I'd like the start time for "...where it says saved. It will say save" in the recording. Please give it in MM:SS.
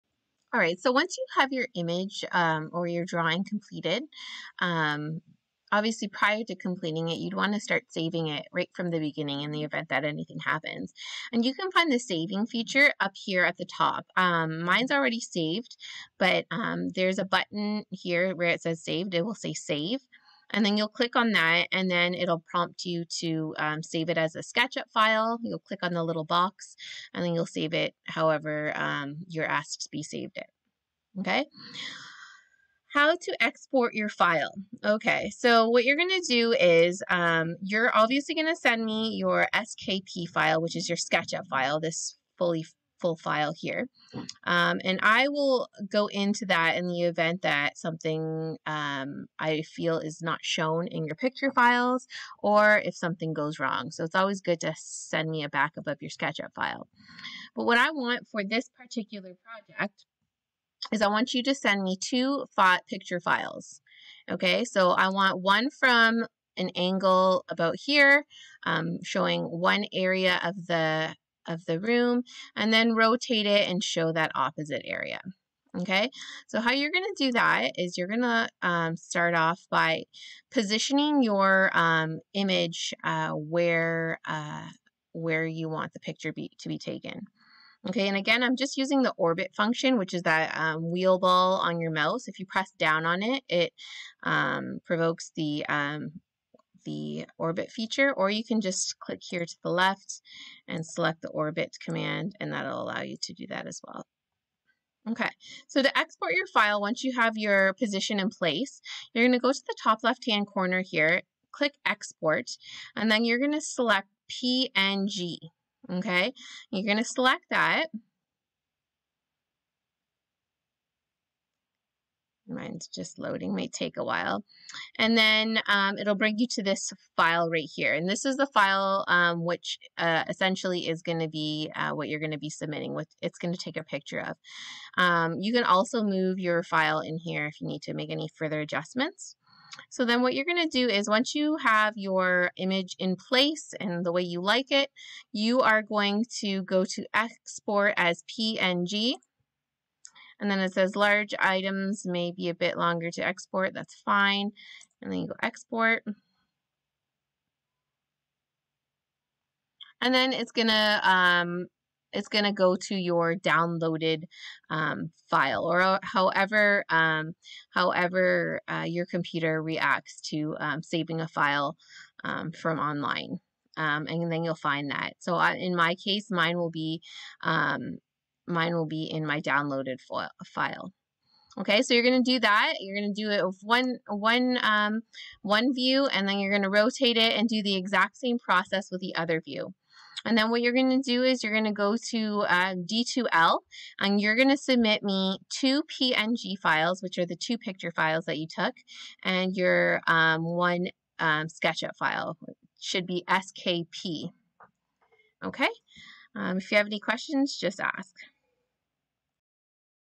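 00:18.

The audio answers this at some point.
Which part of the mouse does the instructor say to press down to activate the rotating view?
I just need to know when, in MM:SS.
01:30.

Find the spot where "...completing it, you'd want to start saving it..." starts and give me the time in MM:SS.
00:06.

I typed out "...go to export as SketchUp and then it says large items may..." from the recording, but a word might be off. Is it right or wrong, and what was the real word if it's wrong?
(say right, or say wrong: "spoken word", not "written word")
wrong: "PNG", not "SketchUp".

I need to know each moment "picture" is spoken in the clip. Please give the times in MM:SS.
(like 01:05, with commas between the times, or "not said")
00:51, 01:02, 01:26, 02:13, 03:17.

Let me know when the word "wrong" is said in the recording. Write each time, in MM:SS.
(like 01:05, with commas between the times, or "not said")
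00:53.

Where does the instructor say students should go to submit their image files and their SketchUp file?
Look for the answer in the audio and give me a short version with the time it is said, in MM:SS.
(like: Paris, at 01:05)
D2L, at 03:12.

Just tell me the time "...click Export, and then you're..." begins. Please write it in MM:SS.
01:51.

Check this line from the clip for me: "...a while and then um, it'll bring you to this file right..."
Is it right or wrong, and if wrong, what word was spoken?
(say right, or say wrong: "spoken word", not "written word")
right.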